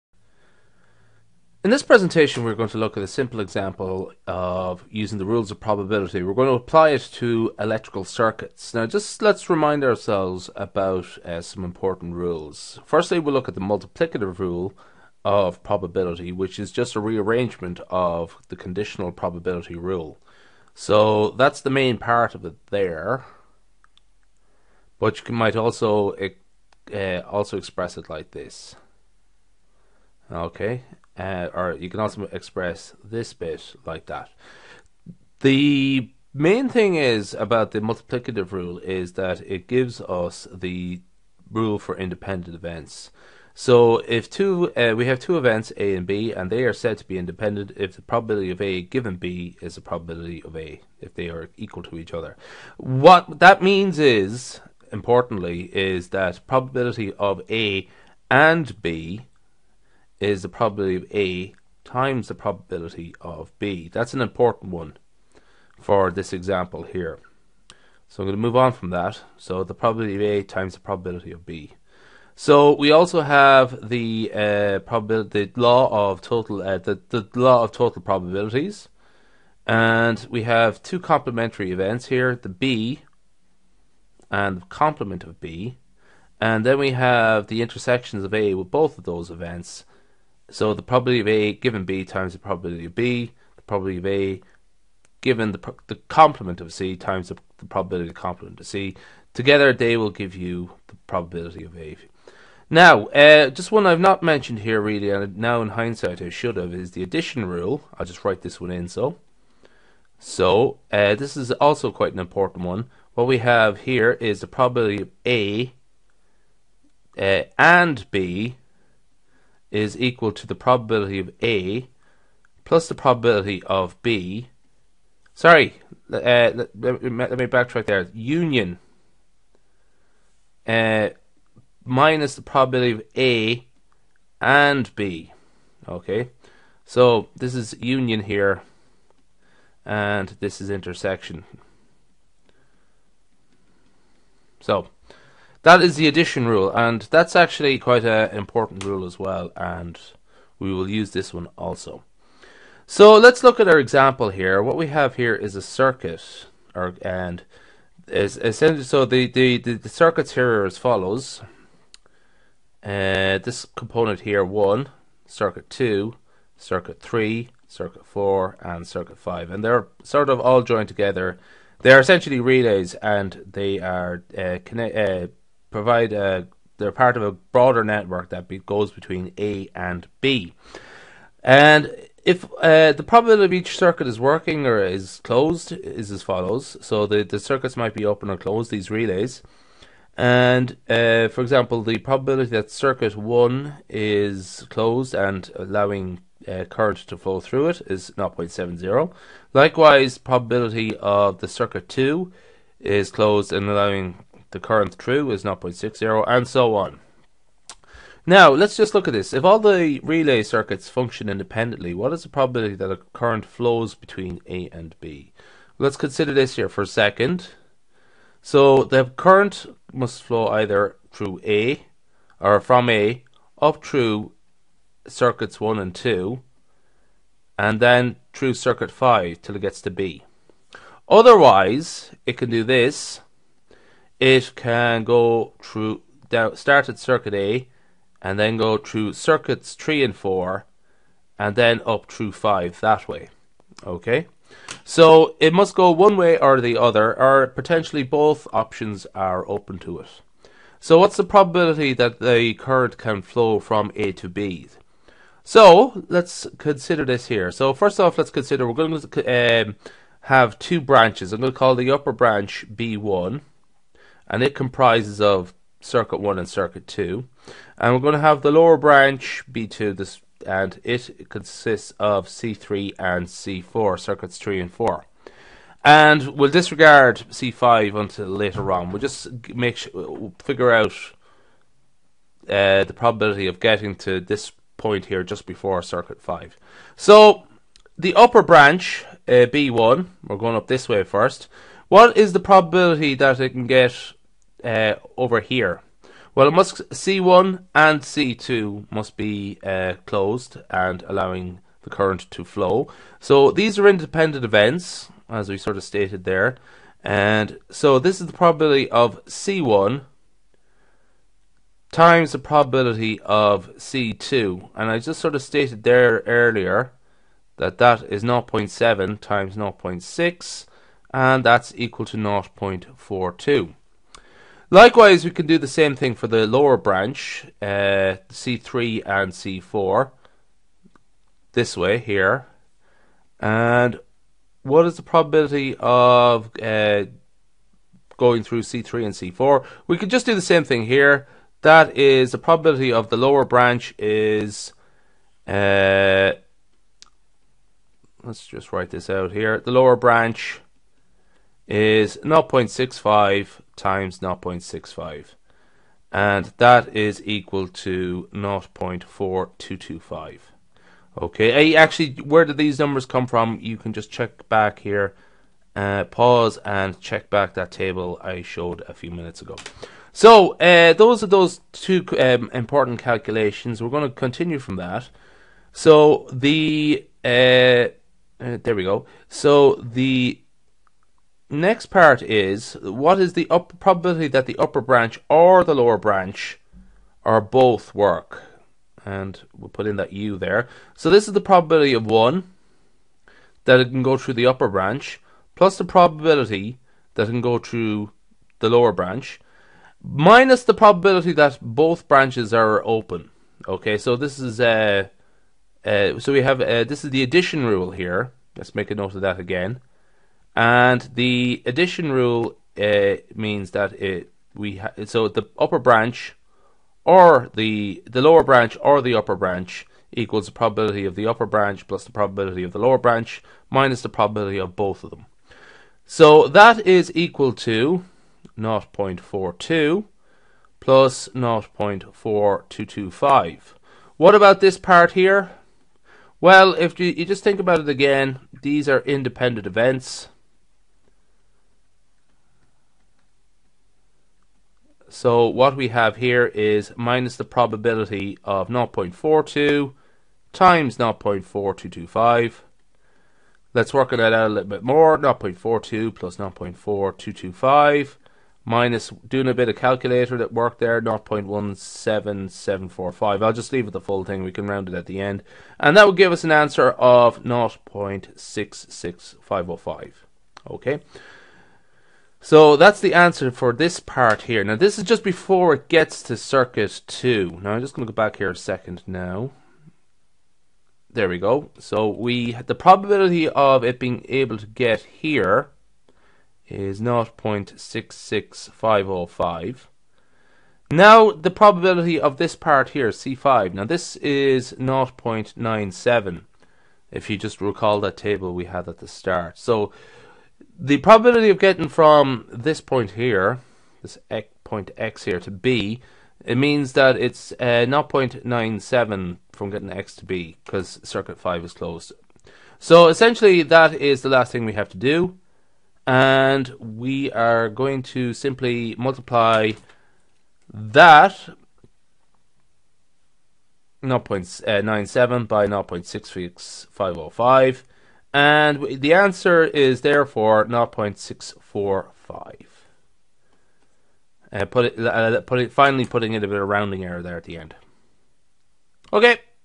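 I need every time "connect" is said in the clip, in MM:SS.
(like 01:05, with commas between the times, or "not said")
02:54.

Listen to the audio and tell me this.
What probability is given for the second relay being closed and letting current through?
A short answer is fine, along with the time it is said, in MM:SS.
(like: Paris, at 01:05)
0.60, at 03:25.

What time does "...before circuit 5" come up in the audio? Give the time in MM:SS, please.
04:45.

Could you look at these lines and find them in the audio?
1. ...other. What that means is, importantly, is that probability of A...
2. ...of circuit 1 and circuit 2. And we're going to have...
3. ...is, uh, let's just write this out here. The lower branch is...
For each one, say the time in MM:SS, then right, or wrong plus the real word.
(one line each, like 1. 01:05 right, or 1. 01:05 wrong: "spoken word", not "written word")
1. 00:52 right
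2. 04:25 right
3. 05:43 right.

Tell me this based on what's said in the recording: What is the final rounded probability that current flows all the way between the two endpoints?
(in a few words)
0.645.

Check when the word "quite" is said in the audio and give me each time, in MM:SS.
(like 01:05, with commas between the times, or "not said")
01:51, 02:27.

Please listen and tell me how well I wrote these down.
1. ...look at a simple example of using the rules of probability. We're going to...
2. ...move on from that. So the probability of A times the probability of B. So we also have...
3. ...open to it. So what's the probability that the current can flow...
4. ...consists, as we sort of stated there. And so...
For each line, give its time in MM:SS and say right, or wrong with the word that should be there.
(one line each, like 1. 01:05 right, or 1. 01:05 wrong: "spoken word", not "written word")
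1. 00:02 right
2. 01:08 right
3. 04:09 right
4. 05:04 wrong: "events", not "consists".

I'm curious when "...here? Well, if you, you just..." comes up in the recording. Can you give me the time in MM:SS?
07:15.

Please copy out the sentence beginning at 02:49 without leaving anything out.
And they're sort of all joined together.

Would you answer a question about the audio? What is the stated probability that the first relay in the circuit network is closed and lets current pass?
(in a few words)
0.70.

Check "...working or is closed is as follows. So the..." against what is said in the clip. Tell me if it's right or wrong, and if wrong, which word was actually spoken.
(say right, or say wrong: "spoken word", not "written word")
right.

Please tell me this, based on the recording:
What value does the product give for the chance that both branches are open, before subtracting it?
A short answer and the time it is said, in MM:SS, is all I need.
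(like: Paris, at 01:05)
0.17745, at 07:41.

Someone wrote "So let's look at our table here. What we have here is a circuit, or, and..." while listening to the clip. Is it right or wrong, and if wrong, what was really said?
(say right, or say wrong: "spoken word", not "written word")
wrong: "example", not "table".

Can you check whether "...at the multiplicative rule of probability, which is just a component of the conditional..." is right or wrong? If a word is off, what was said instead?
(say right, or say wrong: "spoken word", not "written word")
wrong: "rearrangement", not "component".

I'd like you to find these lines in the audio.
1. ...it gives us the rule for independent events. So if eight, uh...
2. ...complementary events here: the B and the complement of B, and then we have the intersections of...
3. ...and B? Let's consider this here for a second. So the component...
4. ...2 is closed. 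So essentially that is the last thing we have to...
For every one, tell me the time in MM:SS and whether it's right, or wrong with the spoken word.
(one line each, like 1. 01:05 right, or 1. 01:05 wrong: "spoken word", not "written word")
1. 00:39 wrong: "two", not "eight"
2. 01:20 right
3. 03:34 wrong: "current", not "component"
4. 08:31 wrong: "5", not "2".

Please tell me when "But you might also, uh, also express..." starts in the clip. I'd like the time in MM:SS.
00:24.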